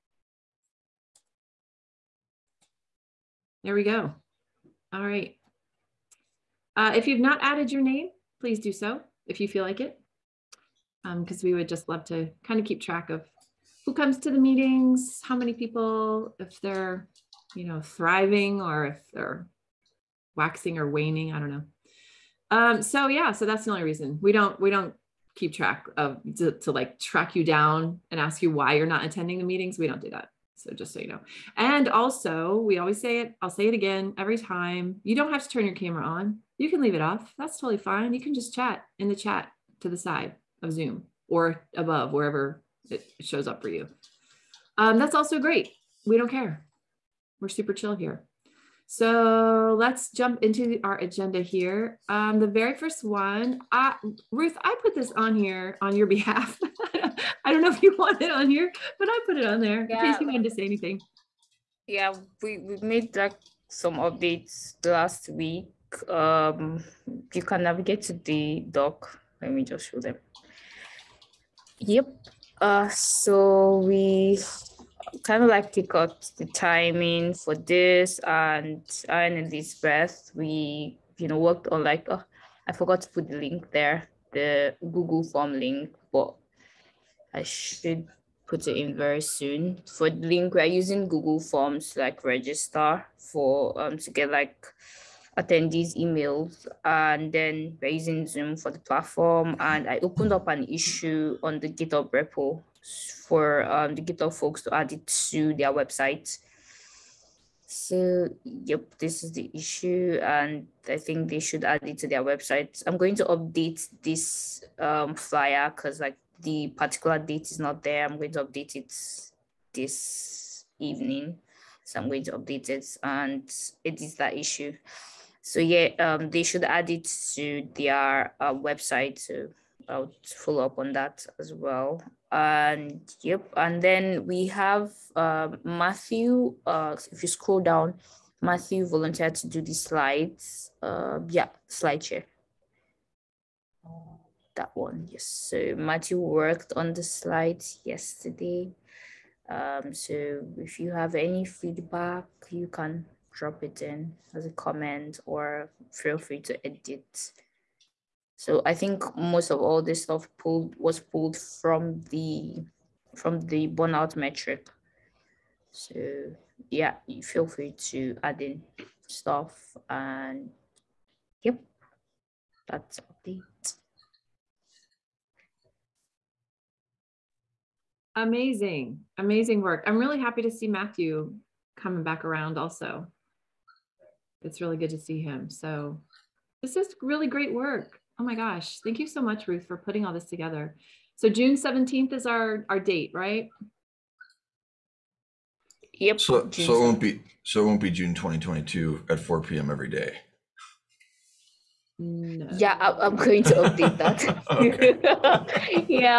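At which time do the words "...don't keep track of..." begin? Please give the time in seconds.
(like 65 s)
24 s.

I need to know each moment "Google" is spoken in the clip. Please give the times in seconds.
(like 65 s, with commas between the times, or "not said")
84 s, 91 s.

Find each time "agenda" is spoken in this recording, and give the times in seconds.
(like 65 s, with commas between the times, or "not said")
50 s.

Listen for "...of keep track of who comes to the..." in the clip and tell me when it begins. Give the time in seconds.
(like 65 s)
12 s.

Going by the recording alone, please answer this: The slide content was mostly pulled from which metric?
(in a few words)
burnout metric.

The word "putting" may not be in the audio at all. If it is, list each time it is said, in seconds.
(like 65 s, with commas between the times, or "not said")
189 s.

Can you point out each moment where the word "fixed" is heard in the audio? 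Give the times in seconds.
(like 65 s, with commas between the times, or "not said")
not said.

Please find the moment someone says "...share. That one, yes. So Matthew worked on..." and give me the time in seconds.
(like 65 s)
142 s.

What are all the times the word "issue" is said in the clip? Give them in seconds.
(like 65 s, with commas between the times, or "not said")
100 s, 109 s, 124 s.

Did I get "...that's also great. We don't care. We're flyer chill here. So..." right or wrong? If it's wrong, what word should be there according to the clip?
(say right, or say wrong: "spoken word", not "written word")
wrong: "super", not "flyer".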